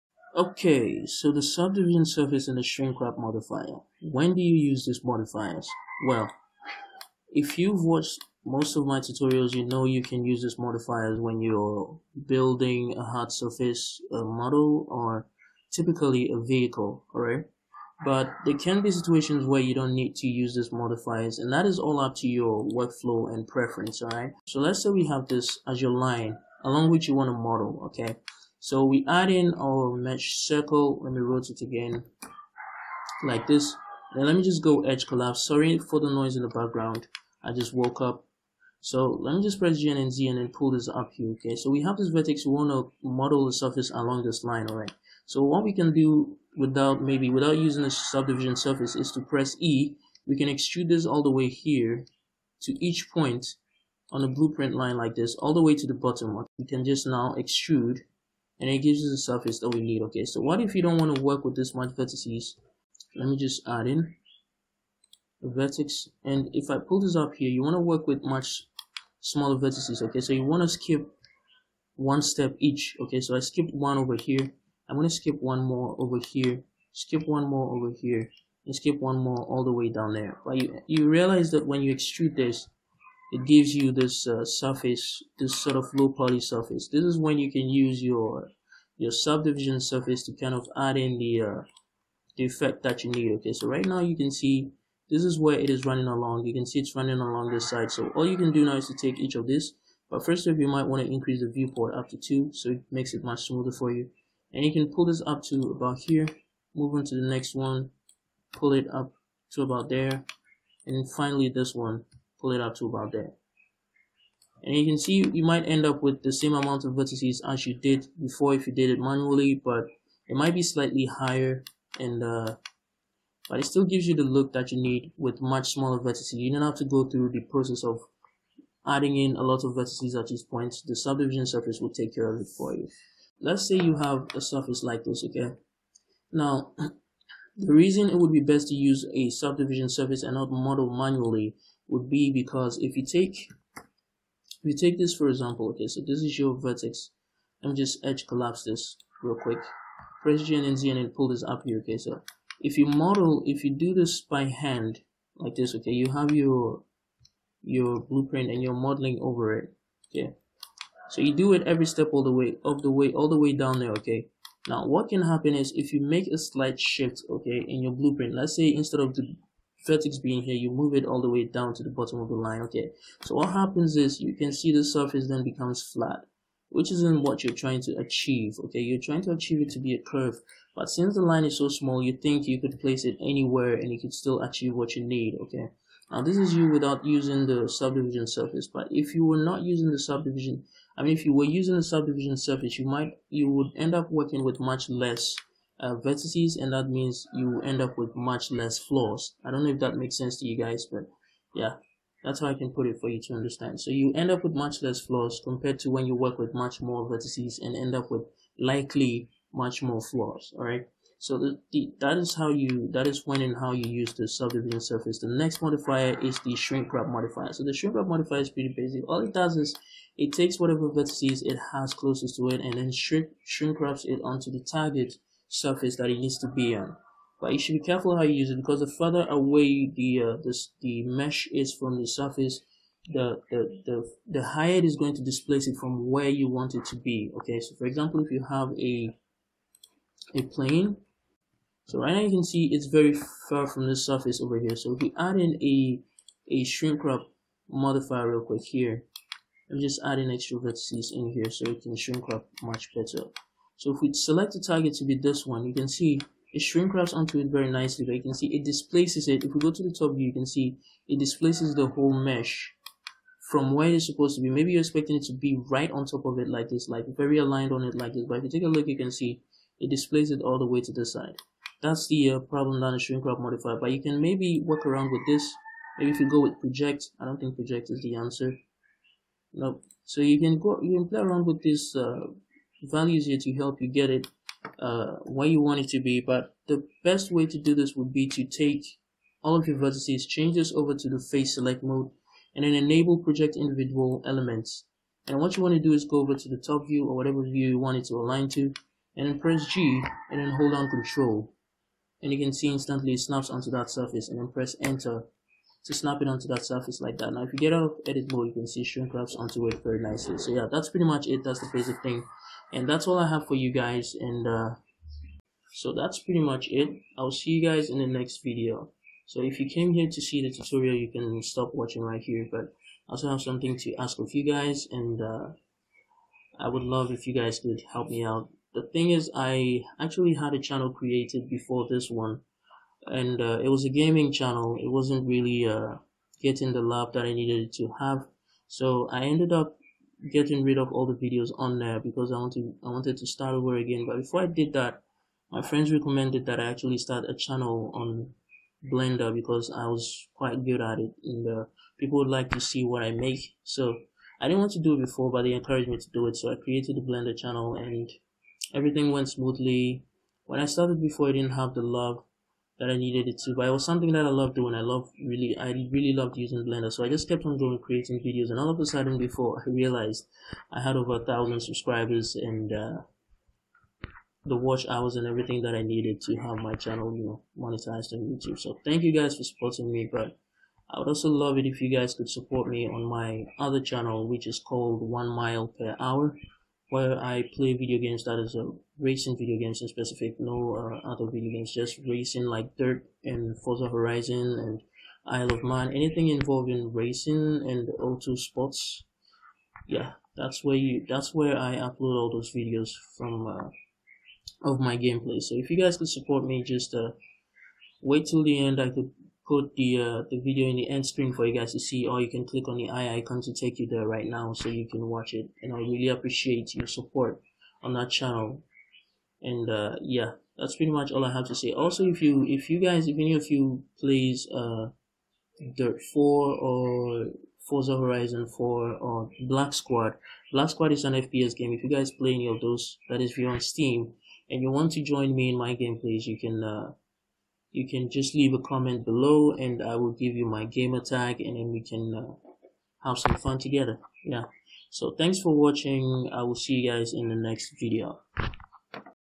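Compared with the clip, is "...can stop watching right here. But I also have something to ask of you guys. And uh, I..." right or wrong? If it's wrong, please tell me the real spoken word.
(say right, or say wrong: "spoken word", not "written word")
right.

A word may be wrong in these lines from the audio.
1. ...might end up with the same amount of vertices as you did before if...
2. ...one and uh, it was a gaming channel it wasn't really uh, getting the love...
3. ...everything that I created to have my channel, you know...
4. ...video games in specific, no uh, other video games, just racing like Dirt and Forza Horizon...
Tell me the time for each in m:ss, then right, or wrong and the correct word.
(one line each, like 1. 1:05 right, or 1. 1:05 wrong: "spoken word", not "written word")
1. 1:55 right
2. 5:32 right
3. 6:15 wrong: "needed", not "created"
4. 6:29 right.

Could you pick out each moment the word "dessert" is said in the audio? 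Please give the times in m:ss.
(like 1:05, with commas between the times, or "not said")
not said.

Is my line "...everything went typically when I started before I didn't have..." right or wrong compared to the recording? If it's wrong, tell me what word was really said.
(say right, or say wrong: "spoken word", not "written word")
wrong: "smoothly", not "typically".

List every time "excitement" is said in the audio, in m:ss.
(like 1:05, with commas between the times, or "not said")
not said.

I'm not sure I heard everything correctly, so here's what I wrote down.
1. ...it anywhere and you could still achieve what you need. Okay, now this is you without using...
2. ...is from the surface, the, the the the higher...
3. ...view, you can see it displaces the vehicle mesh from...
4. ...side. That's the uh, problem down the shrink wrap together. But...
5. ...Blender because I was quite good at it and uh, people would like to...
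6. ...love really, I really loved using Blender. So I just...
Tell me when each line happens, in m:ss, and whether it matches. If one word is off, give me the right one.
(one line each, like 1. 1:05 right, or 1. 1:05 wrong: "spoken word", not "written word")
1. 3:03 right
2. 3:51 right
3. 4:20 wrong: "whole", not "vehicle"
4. 4:31 wrong: "modifier", not "together"
5. 5:48 right
6. 6:04 right.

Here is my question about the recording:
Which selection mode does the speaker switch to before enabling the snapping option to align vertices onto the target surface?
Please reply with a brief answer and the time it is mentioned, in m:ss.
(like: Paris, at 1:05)
face select mode, at 4:51.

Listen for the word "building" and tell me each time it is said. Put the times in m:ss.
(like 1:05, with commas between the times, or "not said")
0:12.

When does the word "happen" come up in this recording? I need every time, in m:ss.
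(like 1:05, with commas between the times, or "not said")
2:45, 2:53.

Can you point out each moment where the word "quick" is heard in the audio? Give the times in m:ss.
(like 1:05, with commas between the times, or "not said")
2:29, 4:08.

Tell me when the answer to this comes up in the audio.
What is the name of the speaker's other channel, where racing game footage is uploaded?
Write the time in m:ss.
6:25.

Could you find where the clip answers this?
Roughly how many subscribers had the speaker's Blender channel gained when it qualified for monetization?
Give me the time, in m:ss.
6:10.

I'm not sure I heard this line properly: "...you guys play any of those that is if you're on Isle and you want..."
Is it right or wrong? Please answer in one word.
wrong.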